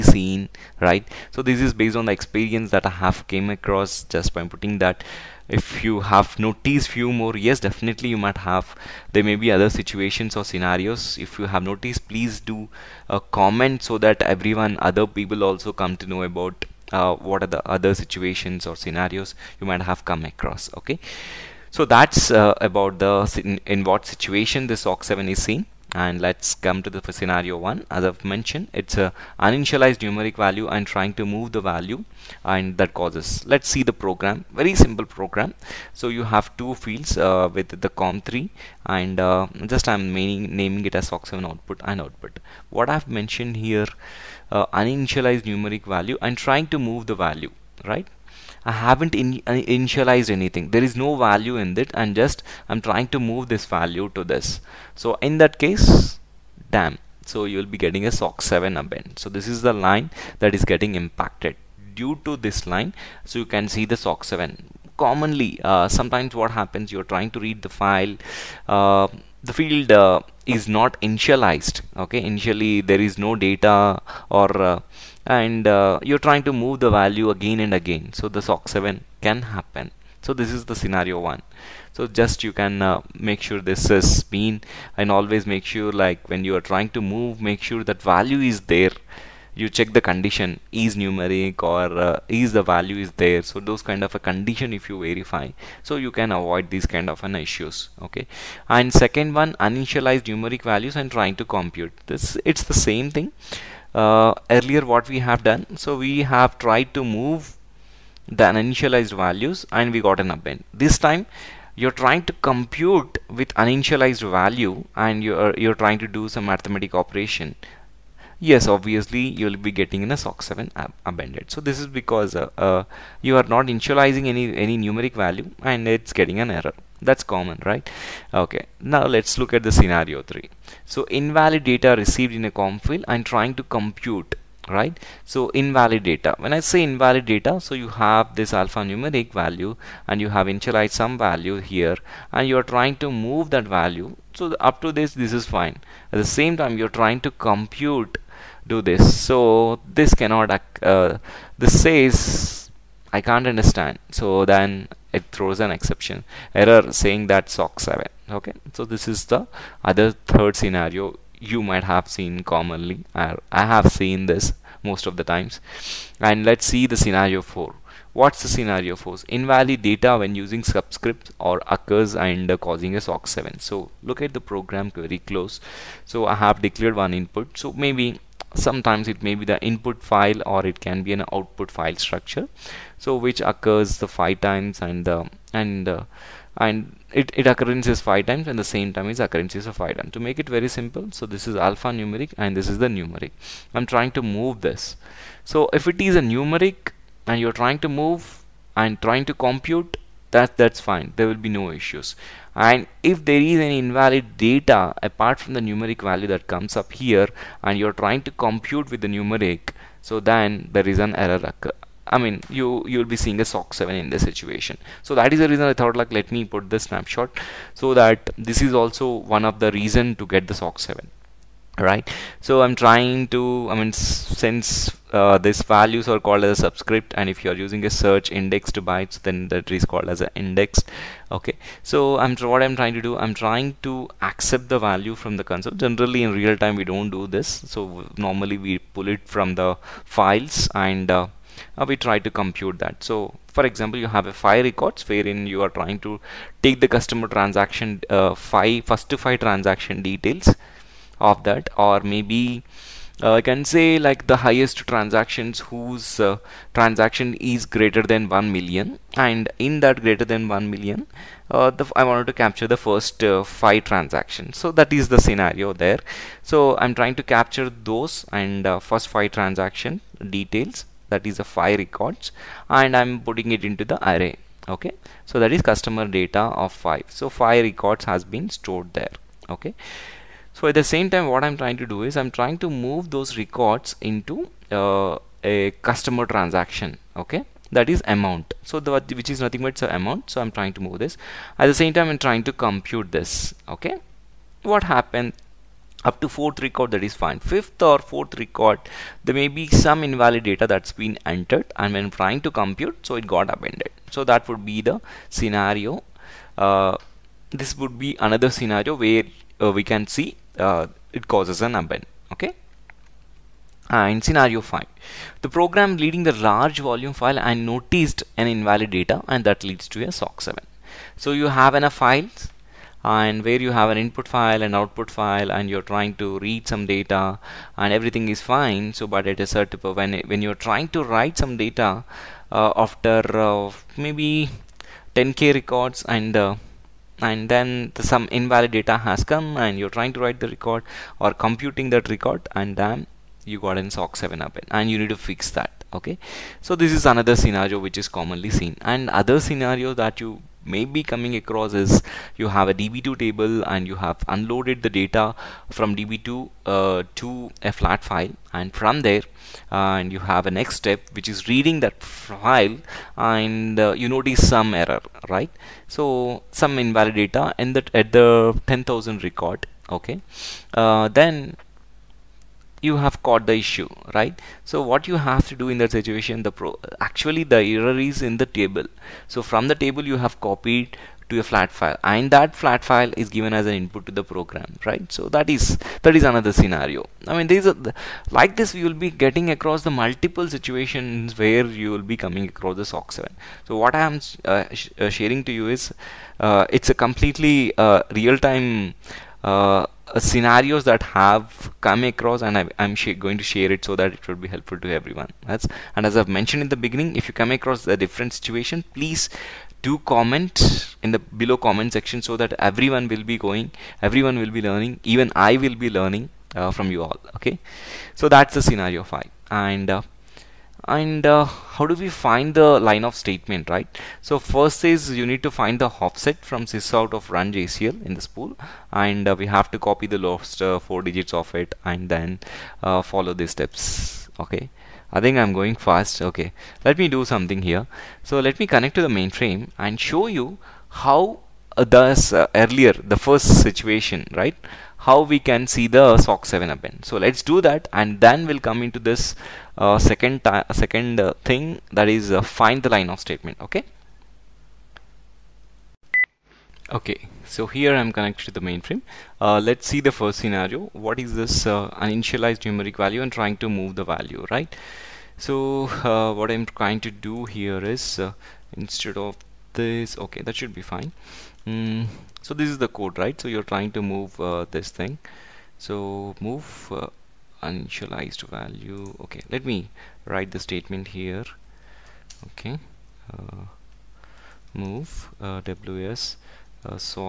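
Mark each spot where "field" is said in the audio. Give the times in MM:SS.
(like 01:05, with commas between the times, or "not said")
00:36, 01:09, 02:12.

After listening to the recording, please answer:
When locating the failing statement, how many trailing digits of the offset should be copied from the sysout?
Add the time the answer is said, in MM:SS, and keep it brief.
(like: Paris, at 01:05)
4, at 07:10.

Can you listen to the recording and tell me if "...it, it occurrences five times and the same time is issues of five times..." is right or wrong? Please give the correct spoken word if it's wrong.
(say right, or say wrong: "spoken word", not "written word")
wrong: "occurrences", not "issues".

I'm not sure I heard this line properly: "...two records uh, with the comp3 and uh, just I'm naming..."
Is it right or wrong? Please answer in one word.
wrong.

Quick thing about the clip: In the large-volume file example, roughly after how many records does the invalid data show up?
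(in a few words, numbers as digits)
10k.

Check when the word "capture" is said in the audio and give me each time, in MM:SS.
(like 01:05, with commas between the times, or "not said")
04:22, 04:27.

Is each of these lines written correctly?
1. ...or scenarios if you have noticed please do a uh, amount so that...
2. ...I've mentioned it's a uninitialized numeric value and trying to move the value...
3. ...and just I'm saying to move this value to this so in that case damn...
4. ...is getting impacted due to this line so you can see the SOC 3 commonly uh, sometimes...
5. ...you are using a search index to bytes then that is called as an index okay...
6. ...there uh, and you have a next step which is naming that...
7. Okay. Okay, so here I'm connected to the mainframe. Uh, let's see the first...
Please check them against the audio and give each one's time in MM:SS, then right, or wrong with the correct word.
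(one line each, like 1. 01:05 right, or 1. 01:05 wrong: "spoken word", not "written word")
1. 00:10 wrong: "comment", not "amount"
2. 00:28 right
3. 00:51 wrong: "trying", not "saying"
4. 01:00 wrong: "7", not "3"
5. 03:47 right
6. 05:59 wrong: "reading", not "naming"
7. 07:33 right.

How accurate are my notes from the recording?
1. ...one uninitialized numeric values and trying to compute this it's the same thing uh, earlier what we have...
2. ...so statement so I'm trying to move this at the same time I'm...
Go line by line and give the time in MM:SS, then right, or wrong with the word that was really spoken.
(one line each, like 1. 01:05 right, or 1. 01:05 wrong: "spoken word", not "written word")
1. 01:39 right
2. 04:49 wrong: "amount", not "statement".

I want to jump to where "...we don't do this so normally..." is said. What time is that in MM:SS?
03:56.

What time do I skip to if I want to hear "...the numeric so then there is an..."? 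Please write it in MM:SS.
03:29.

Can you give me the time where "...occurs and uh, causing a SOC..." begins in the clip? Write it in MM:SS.
02:51.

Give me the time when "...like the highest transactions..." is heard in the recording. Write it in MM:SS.
04:14.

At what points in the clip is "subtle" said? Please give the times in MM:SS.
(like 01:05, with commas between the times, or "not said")
not said.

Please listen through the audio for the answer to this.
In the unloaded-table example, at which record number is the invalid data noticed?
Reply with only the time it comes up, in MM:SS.
06:08.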